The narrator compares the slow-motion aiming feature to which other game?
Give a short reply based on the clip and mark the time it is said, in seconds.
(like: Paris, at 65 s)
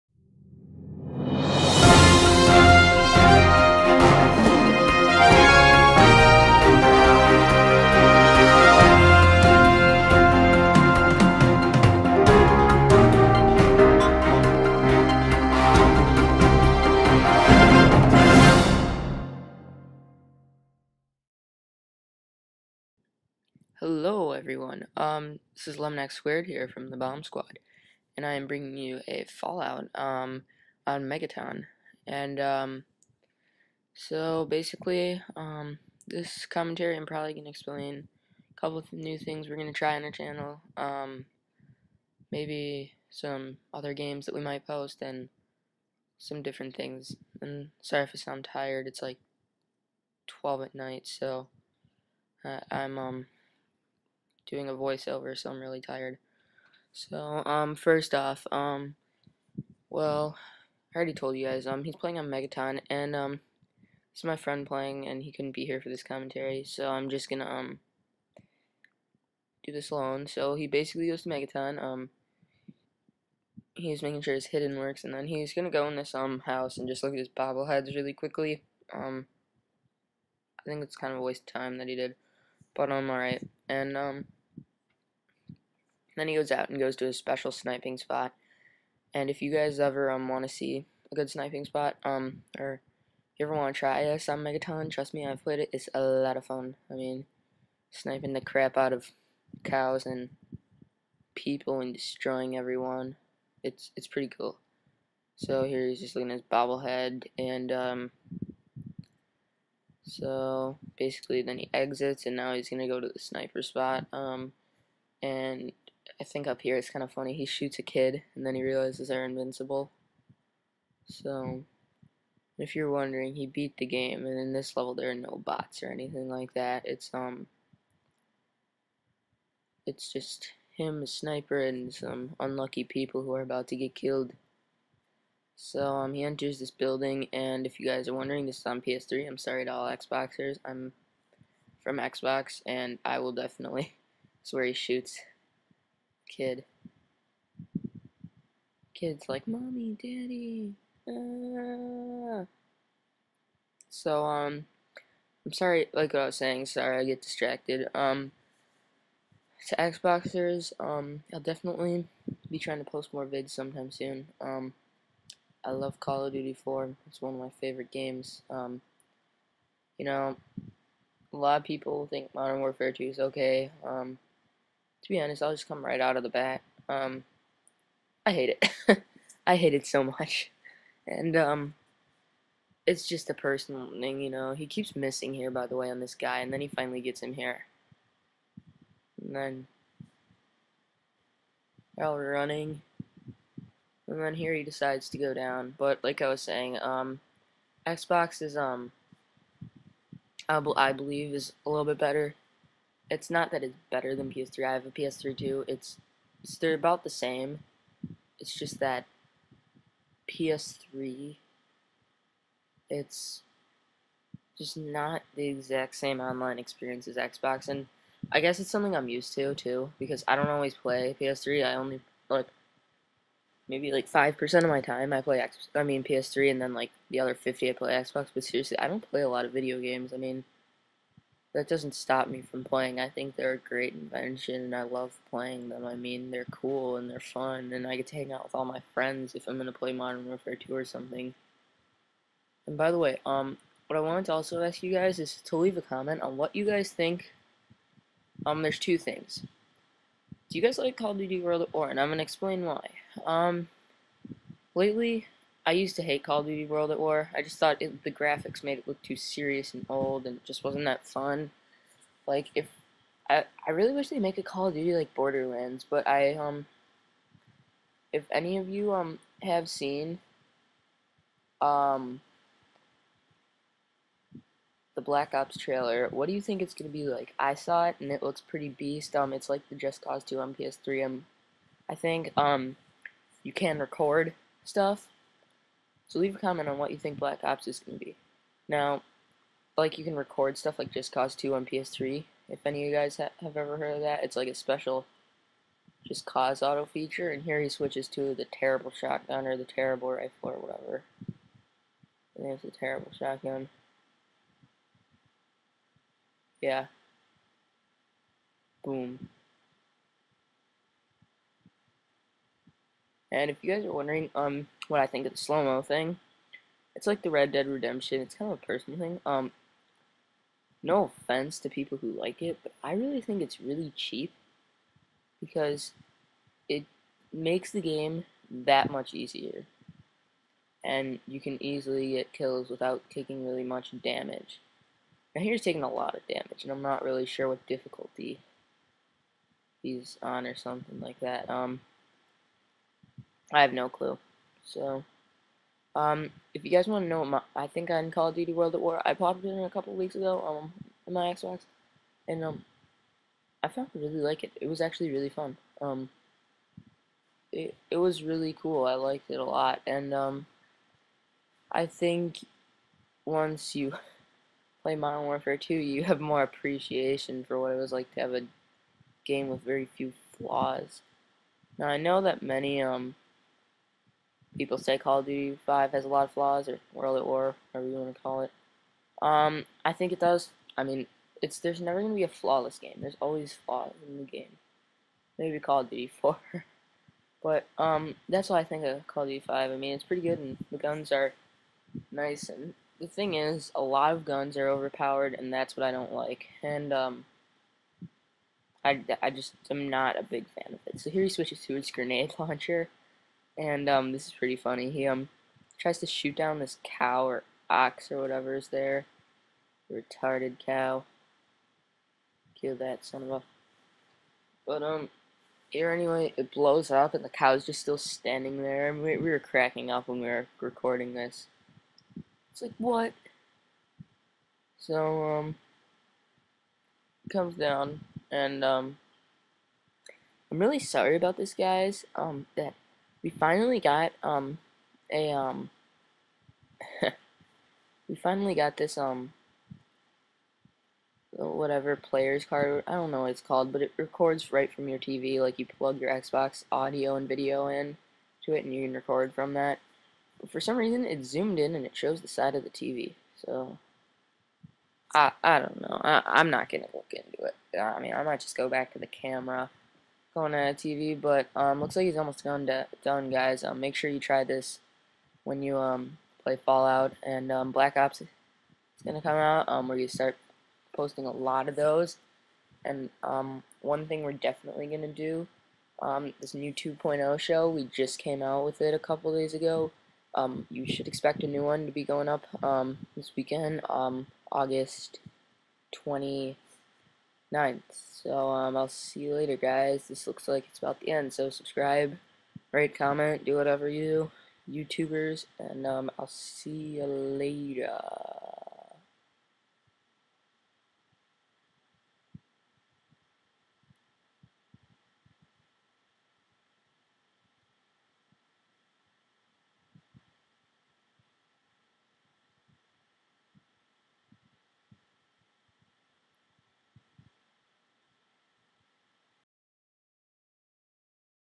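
Red Dead Redemption, at 317 s.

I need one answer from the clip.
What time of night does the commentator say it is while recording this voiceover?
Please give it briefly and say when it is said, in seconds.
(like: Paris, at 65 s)
12, at 50 s.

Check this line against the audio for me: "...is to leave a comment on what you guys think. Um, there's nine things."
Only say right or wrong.
wrong.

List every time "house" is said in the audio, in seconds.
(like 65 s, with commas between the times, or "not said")
76 s.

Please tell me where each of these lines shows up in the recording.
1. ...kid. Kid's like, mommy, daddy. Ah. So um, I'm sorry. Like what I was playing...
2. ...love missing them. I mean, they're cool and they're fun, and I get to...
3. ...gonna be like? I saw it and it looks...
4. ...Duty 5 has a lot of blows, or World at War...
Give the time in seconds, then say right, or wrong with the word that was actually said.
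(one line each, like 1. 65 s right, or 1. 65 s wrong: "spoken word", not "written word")
1. 146 s wrong: "saying", not "playing"
2. 234 s wrong: "playing", not "missing"
3. 276 s right
4. 375 s wrong: "flaws", not "blows".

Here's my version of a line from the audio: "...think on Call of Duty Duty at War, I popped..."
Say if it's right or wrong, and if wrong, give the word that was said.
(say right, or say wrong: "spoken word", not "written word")
wrong: "World", not "Duty".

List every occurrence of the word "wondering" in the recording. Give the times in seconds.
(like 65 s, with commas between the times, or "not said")
122 s, 138 s, 313 s.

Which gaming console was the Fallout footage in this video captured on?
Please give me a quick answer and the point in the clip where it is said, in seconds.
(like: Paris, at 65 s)
PS3, at 138 s.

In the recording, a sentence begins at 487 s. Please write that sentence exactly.
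So um, I'll see you later, guys.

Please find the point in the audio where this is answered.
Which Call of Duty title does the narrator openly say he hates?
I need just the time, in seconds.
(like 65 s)
172 s.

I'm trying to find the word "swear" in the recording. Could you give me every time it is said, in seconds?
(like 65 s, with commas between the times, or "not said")
144 s.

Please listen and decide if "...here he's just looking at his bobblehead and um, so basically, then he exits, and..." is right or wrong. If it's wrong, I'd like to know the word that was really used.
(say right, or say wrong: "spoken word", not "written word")
right.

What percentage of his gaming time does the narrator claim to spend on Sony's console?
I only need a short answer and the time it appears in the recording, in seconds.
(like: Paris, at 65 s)
5%, at 224 s.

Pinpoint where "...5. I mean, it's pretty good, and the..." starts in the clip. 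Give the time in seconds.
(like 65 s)
389 s.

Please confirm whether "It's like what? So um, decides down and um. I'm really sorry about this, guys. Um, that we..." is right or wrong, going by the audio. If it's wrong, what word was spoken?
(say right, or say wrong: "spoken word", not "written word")
wrong: "comes", not "decides".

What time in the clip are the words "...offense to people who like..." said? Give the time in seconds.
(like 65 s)
321 s.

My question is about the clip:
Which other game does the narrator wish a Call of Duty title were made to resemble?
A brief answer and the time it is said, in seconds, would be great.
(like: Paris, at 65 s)
Borderlands, at 265 s.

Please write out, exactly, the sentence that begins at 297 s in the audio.
And here he switches to the terrible shotgun or the terrible rifle or whatever.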